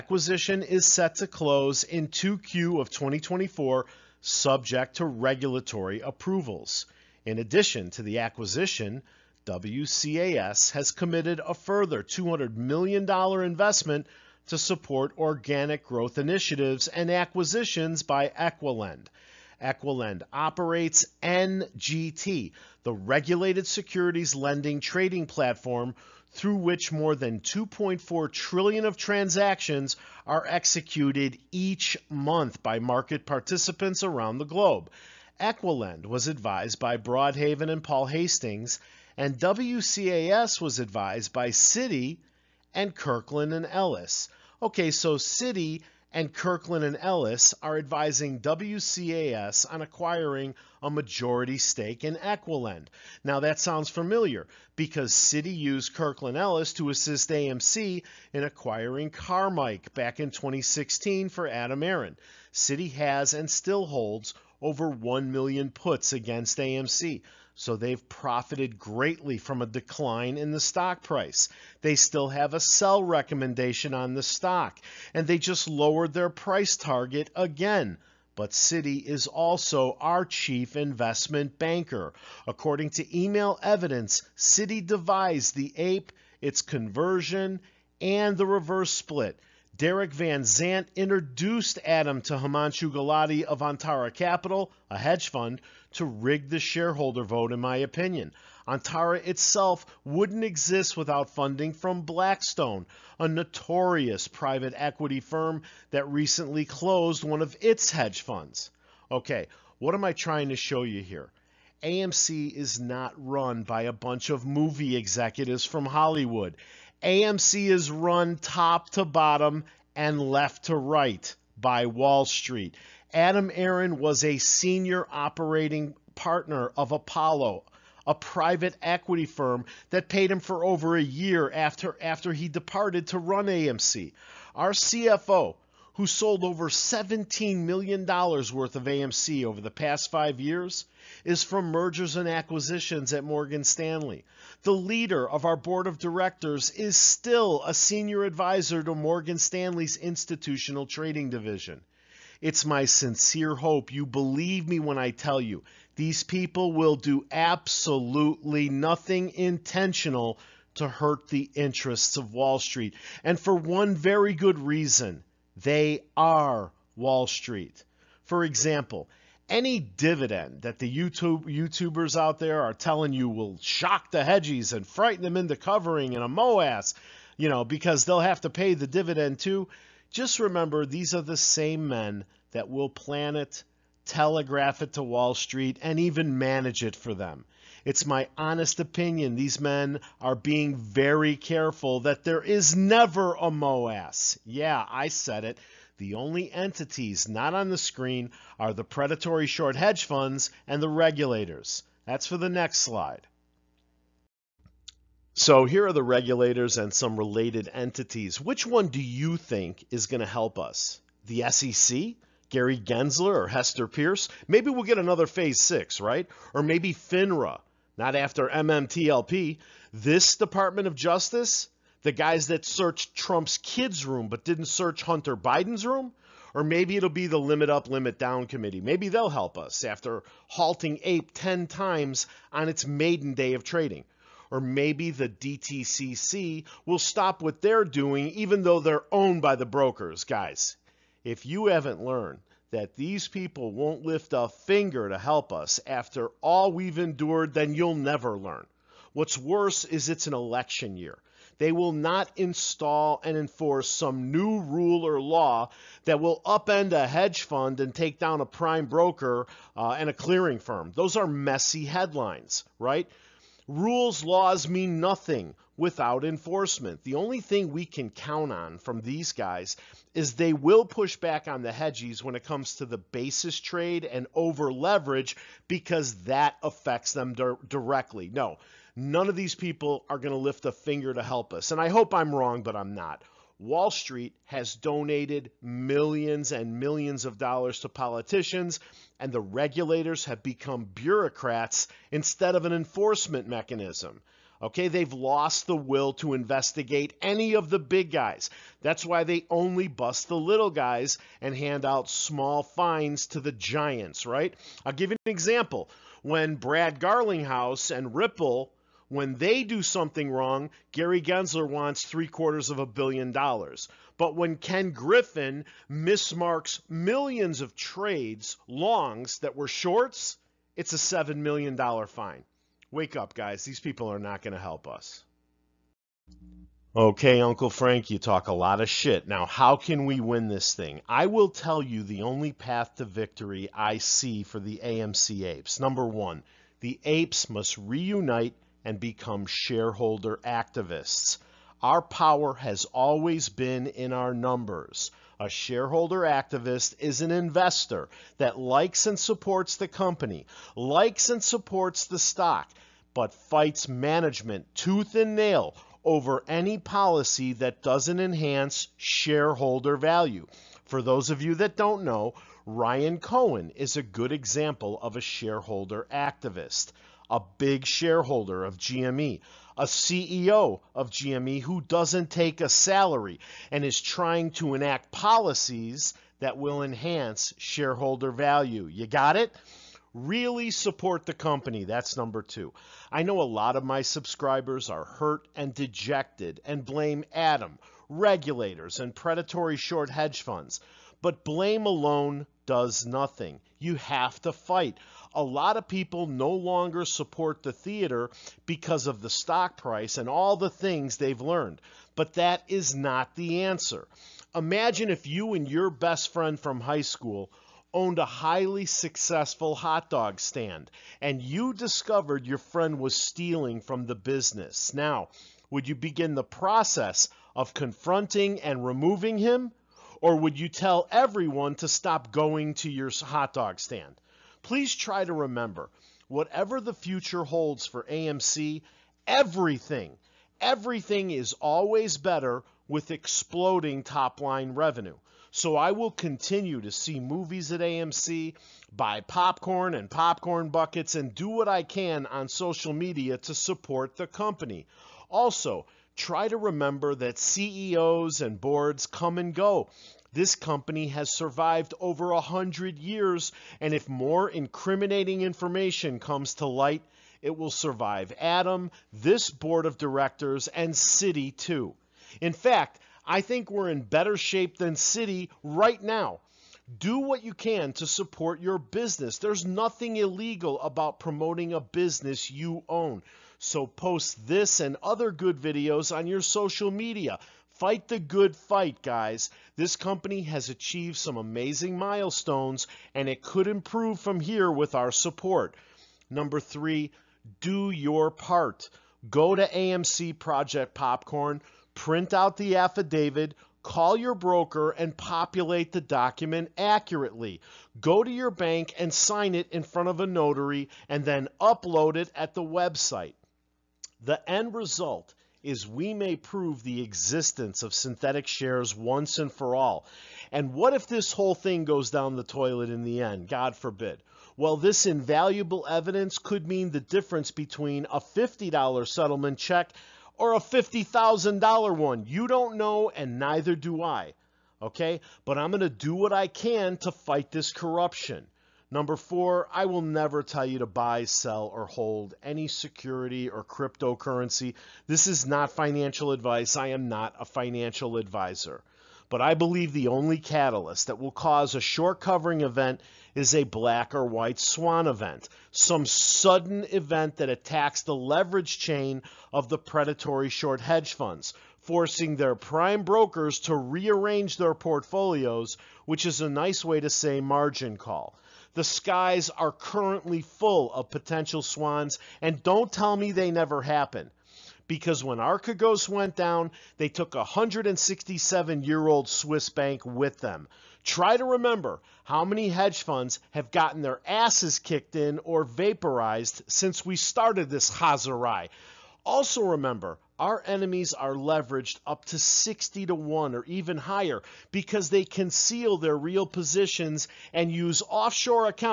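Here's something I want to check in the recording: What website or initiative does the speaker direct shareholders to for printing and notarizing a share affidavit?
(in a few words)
AMC Project Popcorn.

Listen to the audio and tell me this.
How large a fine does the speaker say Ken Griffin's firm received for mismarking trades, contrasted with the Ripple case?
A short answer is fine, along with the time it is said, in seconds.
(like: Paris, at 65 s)
$7 million, at 320 s.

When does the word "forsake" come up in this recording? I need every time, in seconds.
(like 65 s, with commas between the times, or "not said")
not said.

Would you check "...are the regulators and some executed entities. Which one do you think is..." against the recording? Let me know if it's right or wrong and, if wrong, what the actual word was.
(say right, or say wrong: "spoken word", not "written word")
wrong: "related", not "executed".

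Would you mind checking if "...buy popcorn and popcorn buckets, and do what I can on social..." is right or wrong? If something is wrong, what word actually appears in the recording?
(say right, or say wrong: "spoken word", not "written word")
right.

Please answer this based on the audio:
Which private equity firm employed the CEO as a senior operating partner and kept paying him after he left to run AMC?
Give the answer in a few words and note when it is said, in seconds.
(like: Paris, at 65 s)
Apollo, at 126 s.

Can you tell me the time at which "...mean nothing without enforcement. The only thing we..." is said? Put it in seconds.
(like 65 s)
264 s.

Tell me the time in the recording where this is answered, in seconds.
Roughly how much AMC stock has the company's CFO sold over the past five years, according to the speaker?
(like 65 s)
136 s.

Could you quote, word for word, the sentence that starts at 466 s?
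Do what you can to support your business.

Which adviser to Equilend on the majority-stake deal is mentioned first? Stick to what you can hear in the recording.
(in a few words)
Broadhaven.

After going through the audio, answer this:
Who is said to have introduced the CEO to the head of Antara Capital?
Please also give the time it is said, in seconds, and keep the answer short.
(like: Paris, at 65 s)
Derek Van Zant, at 89 s.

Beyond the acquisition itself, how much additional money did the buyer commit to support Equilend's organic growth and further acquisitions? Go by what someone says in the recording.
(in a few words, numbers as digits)
$200 million.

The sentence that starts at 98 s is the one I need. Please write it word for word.
Antara itself wouldn't exist without funding from Blackstone, a notorious private equity firm that recently closed one of its hedge funds.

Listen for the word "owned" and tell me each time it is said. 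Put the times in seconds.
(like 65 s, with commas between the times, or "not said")
239 s, 407 s.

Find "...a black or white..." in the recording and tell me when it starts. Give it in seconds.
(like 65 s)
543 s.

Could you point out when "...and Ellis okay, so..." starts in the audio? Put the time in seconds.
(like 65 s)
43 s.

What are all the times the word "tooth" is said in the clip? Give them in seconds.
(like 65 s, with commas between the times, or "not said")
354 s.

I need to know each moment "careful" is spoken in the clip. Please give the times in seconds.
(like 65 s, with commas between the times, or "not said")
191 s.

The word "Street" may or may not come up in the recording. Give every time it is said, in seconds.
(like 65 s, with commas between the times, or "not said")
122 s, 162 s, 167 s, 185 s, 283 s.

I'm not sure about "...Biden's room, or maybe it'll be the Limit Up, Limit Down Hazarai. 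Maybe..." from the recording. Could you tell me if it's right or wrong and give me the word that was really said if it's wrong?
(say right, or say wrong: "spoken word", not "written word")
wrong: "Committee", not "Hazarai".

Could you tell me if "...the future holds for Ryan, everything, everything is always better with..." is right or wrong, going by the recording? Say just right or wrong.
wrong.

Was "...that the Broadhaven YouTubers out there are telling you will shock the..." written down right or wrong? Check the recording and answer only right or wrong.
wrong.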